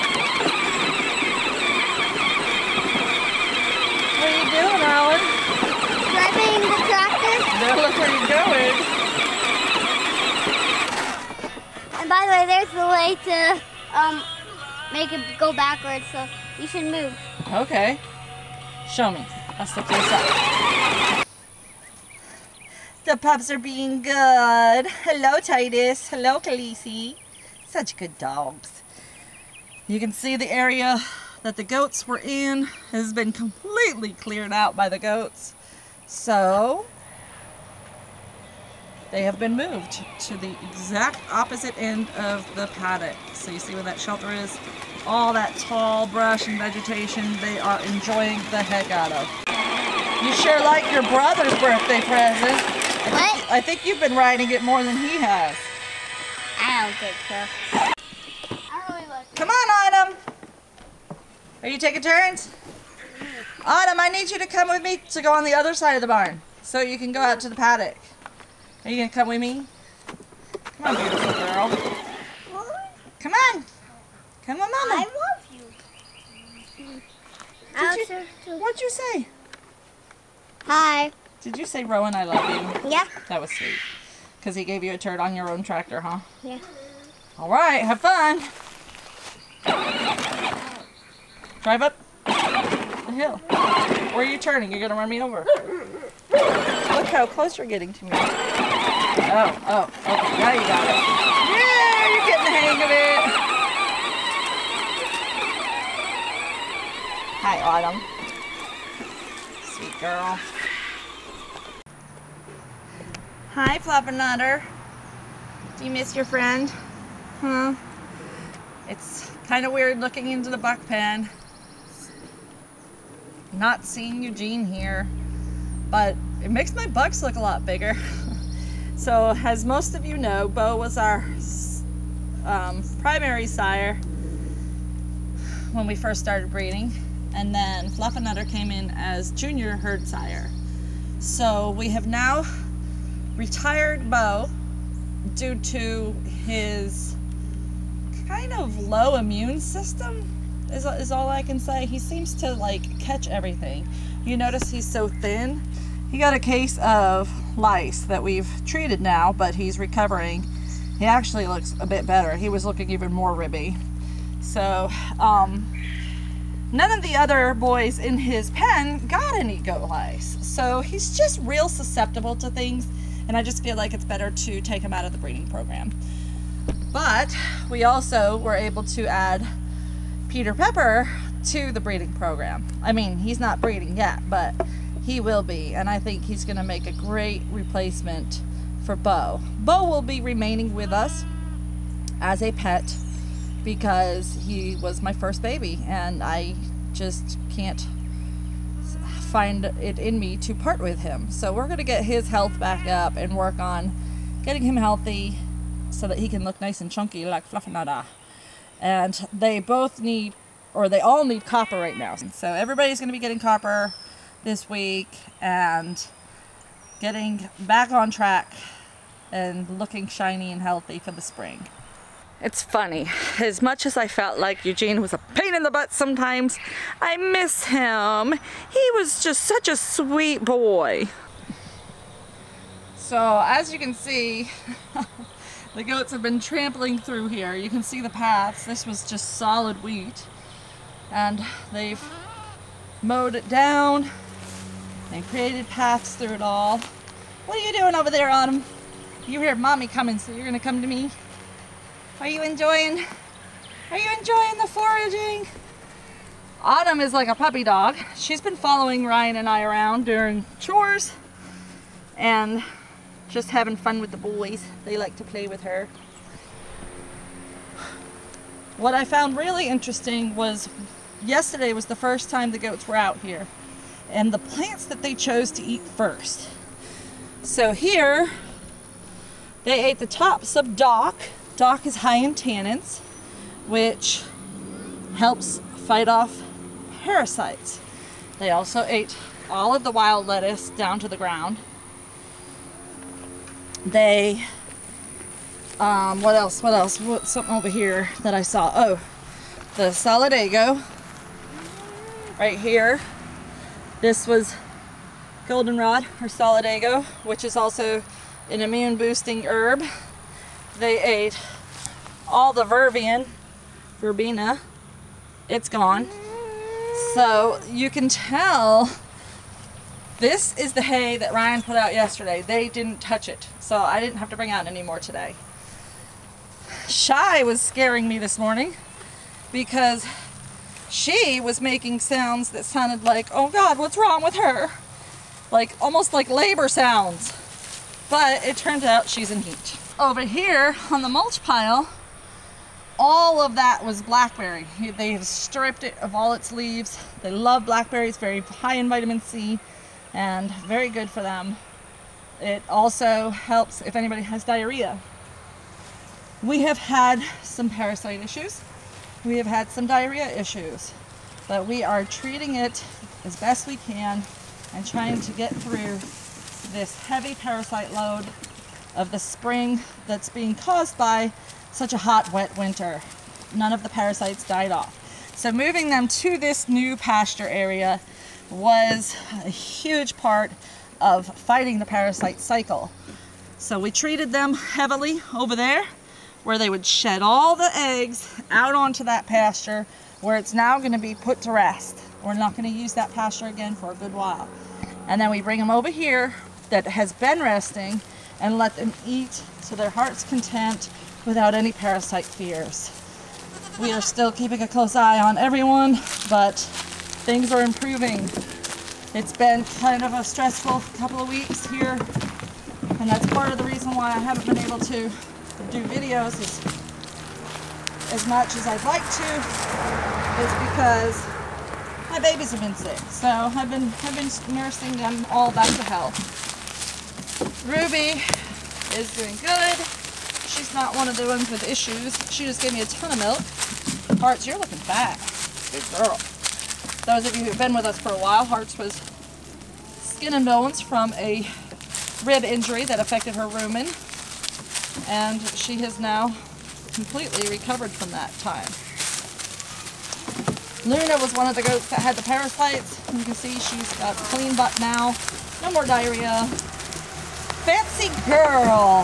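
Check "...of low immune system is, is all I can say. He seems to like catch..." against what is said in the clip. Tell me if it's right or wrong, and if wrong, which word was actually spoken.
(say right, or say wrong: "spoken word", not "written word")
right.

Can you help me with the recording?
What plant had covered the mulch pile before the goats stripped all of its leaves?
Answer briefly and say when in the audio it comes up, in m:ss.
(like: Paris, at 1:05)
Blackberry, at 5:44.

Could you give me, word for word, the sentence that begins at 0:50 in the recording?
You sure like your brother's birthday present.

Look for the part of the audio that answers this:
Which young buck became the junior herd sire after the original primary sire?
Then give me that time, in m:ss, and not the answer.
2:17.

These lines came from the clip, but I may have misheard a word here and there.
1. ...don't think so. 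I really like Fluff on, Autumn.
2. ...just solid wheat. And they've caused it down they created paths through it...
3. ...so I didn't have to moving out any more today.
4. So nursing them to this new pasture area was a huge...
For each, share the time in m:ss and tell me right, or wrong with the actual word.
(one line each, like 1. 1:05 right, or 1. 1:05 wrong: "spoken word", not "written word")
1. 0:56 wrong: "Come", not "Fluff"
2. 3:59 wrong: "mowed", not "caused"
3. 5:23 wrong: "bring", not "moving"
4. 6:15 wrong: "moving", not "nursing".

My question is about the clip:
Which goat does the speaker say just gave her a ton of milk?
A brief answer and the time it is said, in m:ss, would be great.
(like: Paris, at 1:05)
Ruby, at 7:07.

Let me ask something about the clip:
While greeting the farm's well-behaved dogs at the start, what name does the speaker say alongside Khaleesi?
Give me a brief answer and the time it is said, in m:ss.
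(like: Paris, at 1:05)
Titus, at 0:25.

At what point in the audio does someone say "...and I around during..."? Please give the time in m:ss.
4:19.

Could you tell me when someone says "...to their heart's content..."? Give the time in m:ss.
6:39.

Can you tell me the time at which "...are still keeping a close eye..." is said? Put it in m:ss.
6:43.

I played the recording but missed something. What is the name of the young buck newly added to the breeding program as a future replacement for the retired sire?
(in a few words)
Peter Pepper.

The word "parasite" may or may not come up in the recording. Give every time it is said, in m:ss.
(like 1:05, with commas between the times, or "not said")
4:47, 5:57, 6:07, 6:13, 6:21, 6:41, 7:32.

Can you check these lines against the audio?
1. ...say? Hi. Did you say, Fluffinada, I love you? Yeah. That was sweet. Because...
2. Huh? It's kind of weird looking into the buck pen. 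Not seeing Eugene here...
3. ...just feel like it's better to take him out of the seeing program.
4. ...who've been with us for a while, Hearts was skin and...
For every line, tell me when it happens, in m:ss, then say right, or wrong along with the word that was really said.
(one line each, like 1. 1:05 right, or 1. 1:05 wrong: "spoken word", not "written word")
1. 1:18 wrong: "Rowan", not "Fluffinada"
2. 1:57 right
3. 2:53 wrong: "breeding", not "seeing"
4. 7:17 right.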